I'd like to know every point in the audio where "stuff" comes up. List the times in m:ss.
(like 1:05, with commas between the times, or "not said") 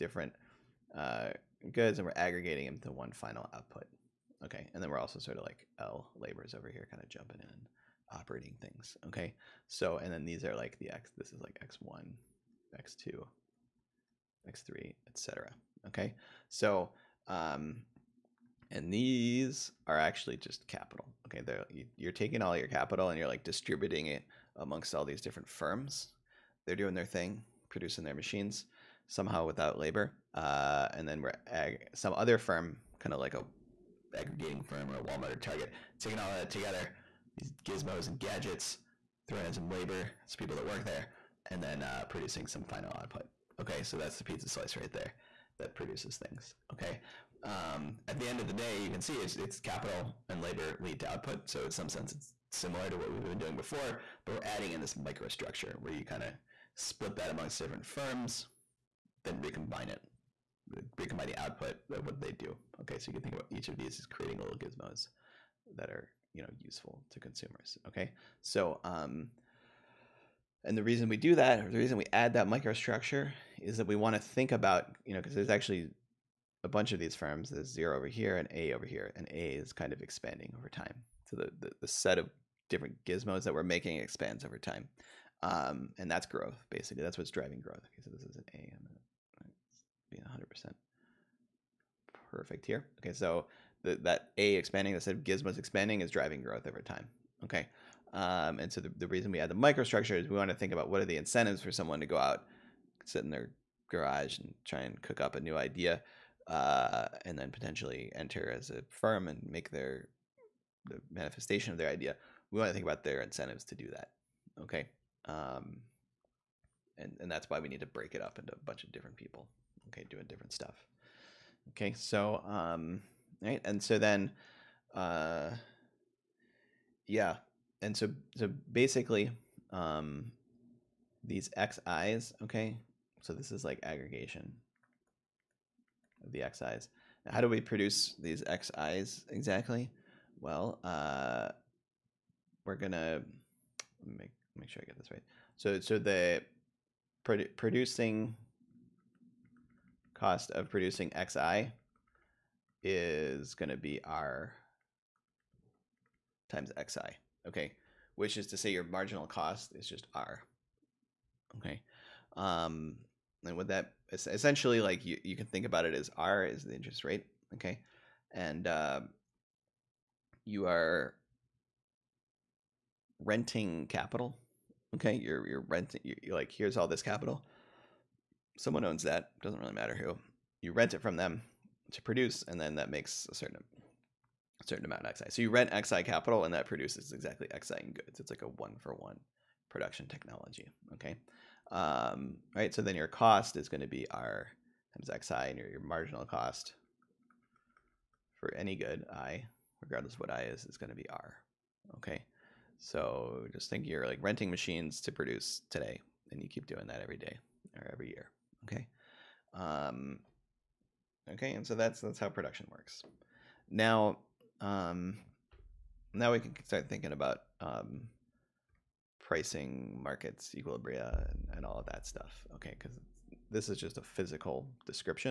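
2:00, 3:42.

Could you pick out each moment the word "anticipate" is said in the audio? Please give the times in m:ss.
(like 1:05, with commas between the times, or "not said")
not said.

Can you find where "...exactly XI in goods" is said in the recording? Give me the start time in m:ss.
3:07.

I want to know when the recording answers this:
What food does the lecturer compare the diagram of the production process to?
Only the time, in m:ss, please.
0:44.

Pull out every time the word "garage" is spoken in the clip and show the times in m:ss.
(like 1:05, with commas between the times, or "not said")
1:43.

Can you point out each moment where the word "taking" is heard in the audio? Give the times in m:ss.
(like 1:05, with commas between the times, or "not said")
0:22, 0:35.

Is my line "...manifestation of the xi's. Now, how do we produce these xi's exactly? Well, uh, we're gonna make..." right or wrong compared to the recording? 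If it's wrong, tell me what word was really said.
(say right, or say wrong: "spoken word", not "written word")
wrong: "aggregation", not "manifestation".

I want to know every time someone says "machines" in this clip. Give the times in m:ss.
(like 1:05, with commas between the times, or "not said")
0:28, 3:24.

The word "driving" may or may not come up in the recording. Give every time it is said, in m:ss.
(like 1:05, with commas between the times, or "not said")
1:27, 1:36.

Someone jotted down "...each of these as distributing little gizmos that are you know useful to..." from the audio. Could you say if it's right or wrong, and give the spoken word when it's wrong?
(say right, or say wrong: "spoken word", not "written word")
wrong: "creating", not "distributing".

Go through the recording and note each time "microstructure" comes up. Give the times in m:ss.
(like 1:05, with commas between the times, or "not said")
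0:54, 1:12, 1:39.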